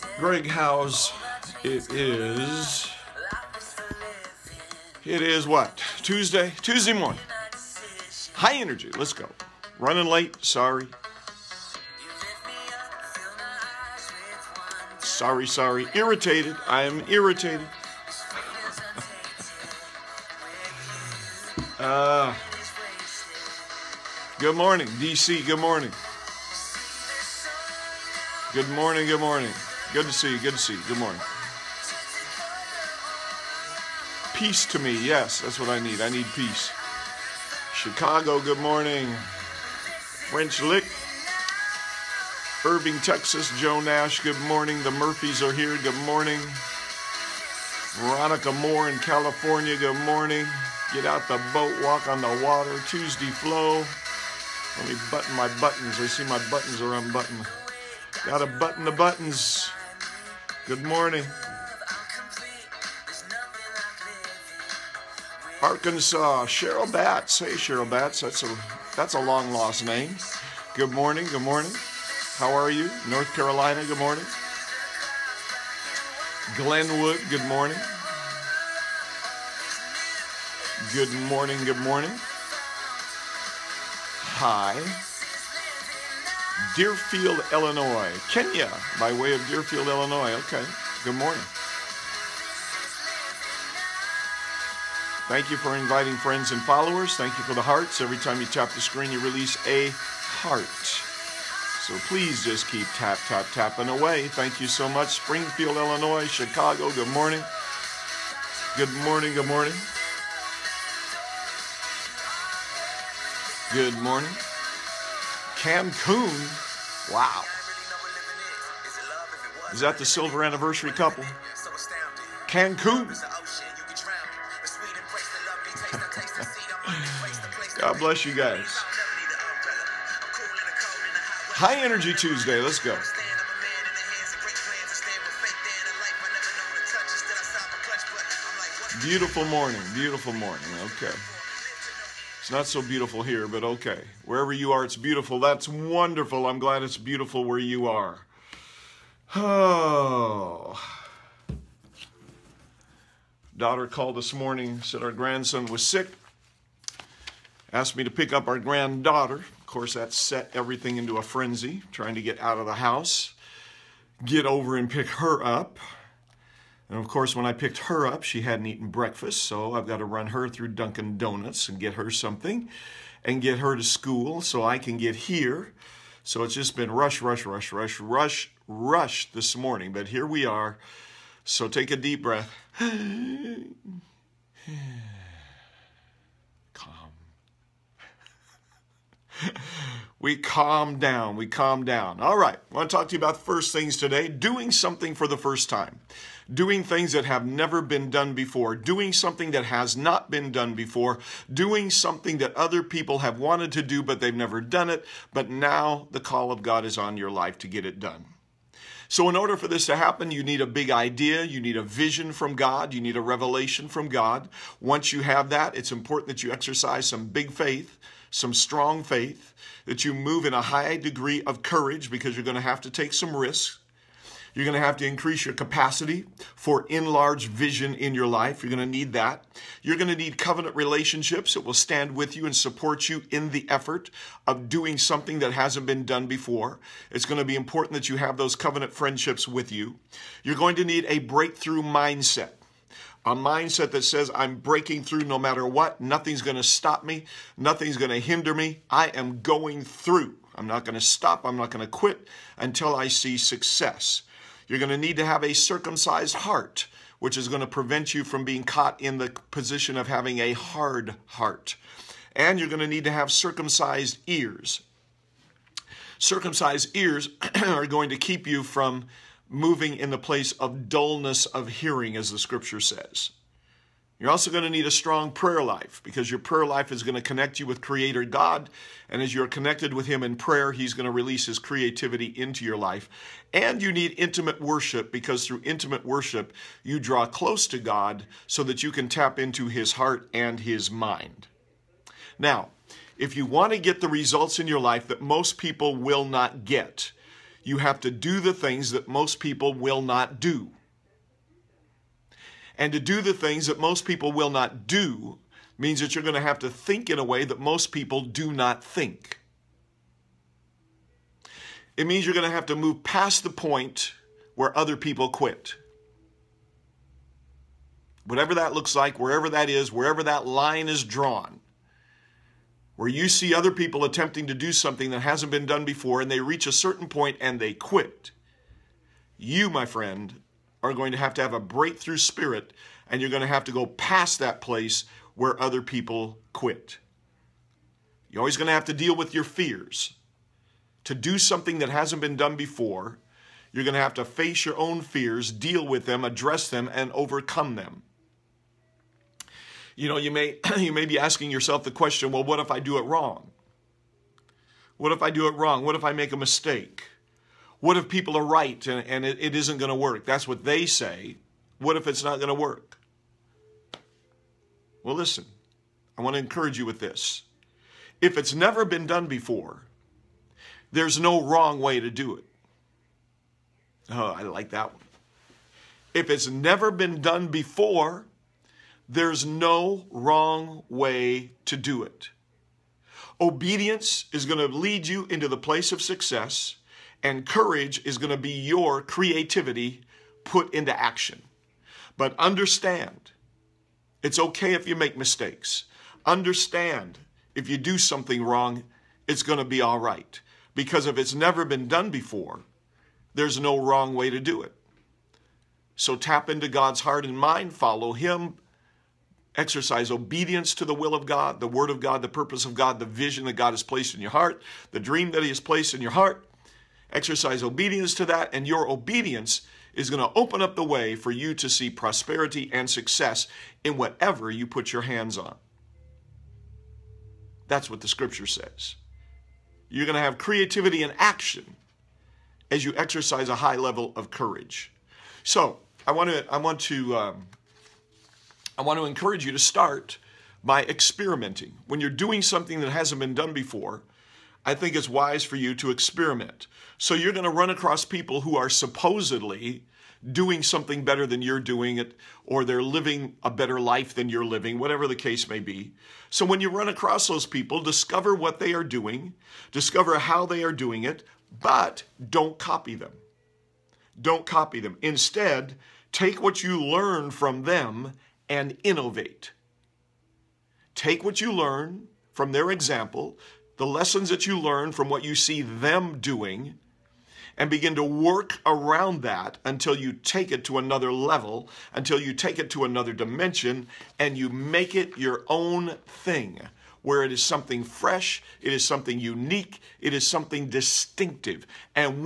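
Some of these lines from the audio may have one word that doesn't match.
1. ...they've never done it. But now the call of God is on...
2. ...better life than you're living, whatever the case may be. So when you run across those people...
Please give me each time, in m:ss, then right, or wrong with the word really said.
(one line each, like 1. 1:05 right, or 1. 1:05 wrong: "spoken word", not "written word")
1. 3:24 right
2. 7:33 right.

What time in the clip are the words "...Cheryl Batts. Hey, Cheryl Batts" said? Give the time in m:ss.
1:06.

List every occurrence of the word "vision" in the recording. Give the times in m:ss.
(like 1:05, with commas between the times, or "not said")
3:31, 3:47, 6:53.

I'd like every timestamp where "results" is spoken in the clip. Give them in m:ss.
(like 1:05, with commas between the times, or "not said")
4:54.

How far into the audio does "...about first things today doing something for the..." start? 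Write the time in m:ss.
3:13.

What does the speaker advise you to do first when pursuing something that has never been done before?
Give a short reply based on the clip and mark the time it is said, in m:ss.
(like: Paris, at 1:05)
Experiment, at 7:20.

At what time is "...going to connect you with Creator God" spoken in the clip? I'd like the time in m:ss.
4:37.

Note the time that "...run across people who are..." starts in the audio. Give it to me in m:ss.
7:27.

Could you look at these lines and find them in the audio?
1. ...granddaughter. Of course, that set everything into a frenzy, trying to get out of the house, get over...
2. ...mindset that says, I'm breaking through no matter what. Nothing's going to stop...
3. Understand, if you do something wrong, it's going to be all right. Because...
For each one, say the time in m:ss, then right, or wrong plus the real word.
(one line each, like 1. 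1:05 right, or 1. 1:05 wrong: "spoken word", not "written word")
1. 2:38 right
2. 4:03 right
3. 6:36 right.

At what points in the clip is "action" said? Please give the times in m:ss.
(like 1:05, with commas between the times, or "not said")
6:30, 7:11.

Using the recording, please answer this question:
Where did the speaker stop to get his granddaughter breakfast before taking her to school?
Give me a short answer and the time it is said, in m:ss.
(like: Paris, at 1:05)
Dunkin' Donuts, at 2:50.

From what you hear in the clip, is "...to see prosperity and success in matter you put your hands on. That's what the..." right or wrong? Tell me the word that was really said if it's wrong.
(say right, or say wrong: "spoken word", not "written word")
wrong: "whatever", not "matter".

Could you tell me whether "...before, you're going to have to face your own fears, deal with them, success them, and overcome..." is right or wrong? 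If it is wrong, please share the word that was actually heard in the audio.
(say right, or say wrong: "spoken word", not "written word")
wrong: "address", not "success".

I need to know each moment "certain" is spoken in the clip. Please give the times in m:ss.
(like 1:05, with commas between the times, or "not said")
5:26.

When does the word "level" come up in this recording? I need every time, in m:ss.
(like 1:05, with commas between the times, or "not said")
7:13, 8:01.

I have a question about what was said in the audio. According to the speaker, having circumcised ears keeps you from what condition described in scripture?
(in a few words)
Dullness of hearing.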